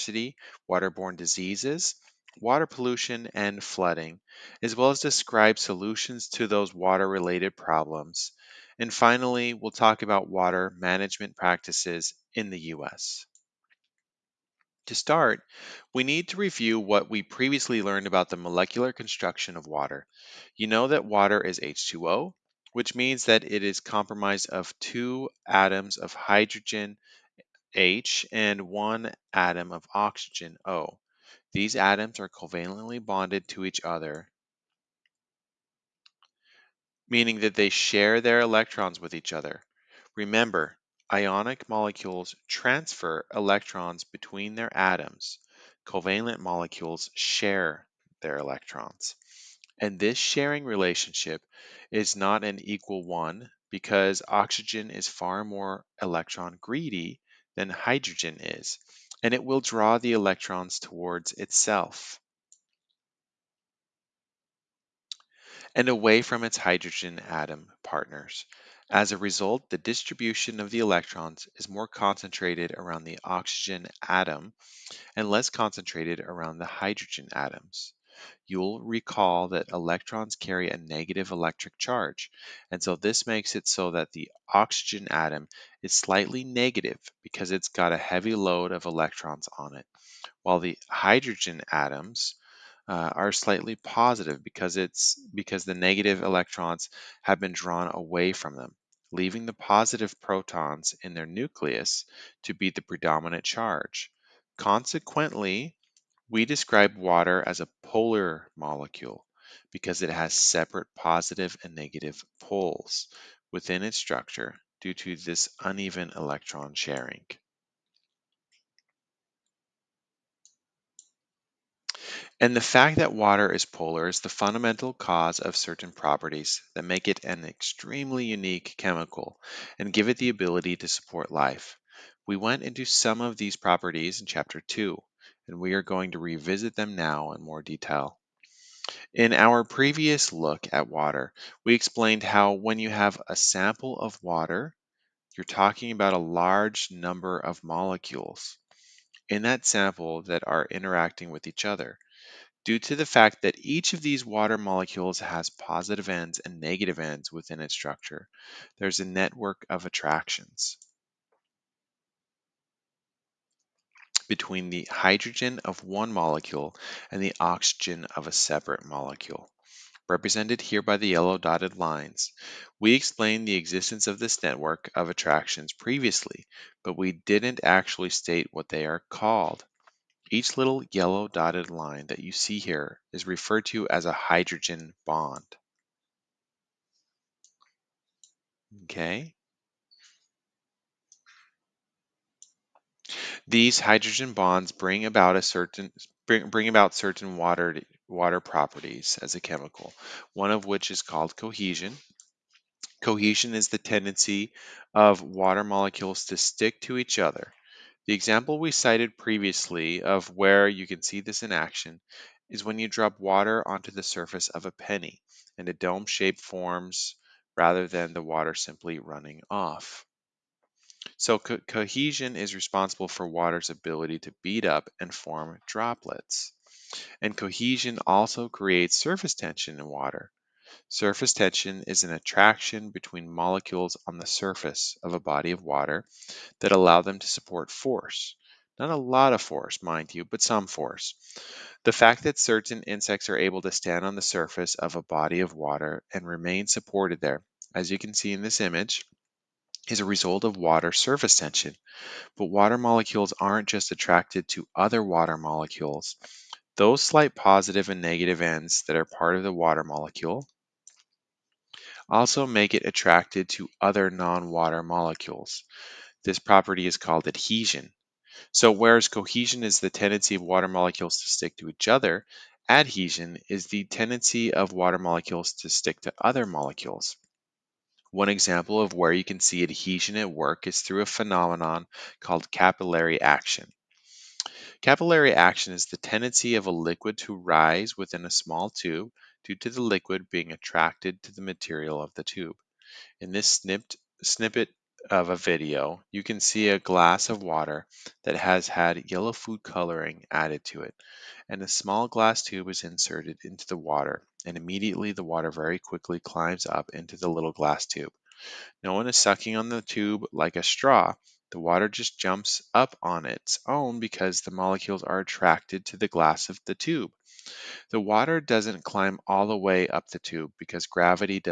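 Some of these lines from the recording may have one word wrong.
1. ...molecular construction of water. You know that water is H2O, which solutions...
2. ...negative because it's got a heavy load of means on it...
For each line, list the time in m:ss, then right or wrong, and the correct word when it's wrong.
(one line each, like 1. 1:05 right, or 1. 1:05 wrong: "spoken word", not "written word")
1. 0:18 wrong: "means", not "solutions"
2. 1:26 wrong: "electrons", not "means".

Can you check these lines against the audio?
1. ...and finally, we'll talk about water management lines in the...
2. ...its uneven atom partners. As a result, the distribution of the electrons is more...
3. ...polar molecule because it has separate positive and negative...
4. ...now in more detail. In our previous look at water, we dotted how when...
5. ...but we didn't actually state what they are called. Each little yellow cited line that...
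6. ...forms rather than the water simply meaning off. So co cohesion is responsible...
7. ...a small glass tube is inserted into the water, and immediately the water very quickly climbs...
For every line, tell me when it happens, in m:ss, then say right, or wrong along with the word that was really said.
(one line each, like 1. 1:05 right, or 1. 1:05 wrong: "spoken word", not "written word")
1. 0:08 wrong: "practices", not "lines"
2. 1:06 wrong: "hydrogen", not "uneven"
3. 1:47 right
4. 2:16 wrong: "explained", not "dotted"
5. 2:56 wrong: "dotted", not "cited"
6. 3:36 wrong: "running", not "meaning"
7. 5:01 right.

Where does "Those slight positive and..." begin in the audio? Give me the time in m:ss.
4:16.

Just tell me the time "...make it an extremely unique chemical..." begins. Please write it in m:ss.
2:06.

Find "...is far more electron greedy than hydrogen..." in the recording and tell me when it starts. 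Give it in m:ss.
0:54.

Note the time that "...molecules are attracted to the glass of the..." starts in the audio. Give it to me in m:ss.
5:14.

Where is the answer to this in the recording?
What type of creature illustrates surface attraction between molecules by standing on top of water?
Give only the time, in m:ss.
4:02.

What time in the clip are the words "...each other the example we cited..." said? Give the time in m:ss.
3:26.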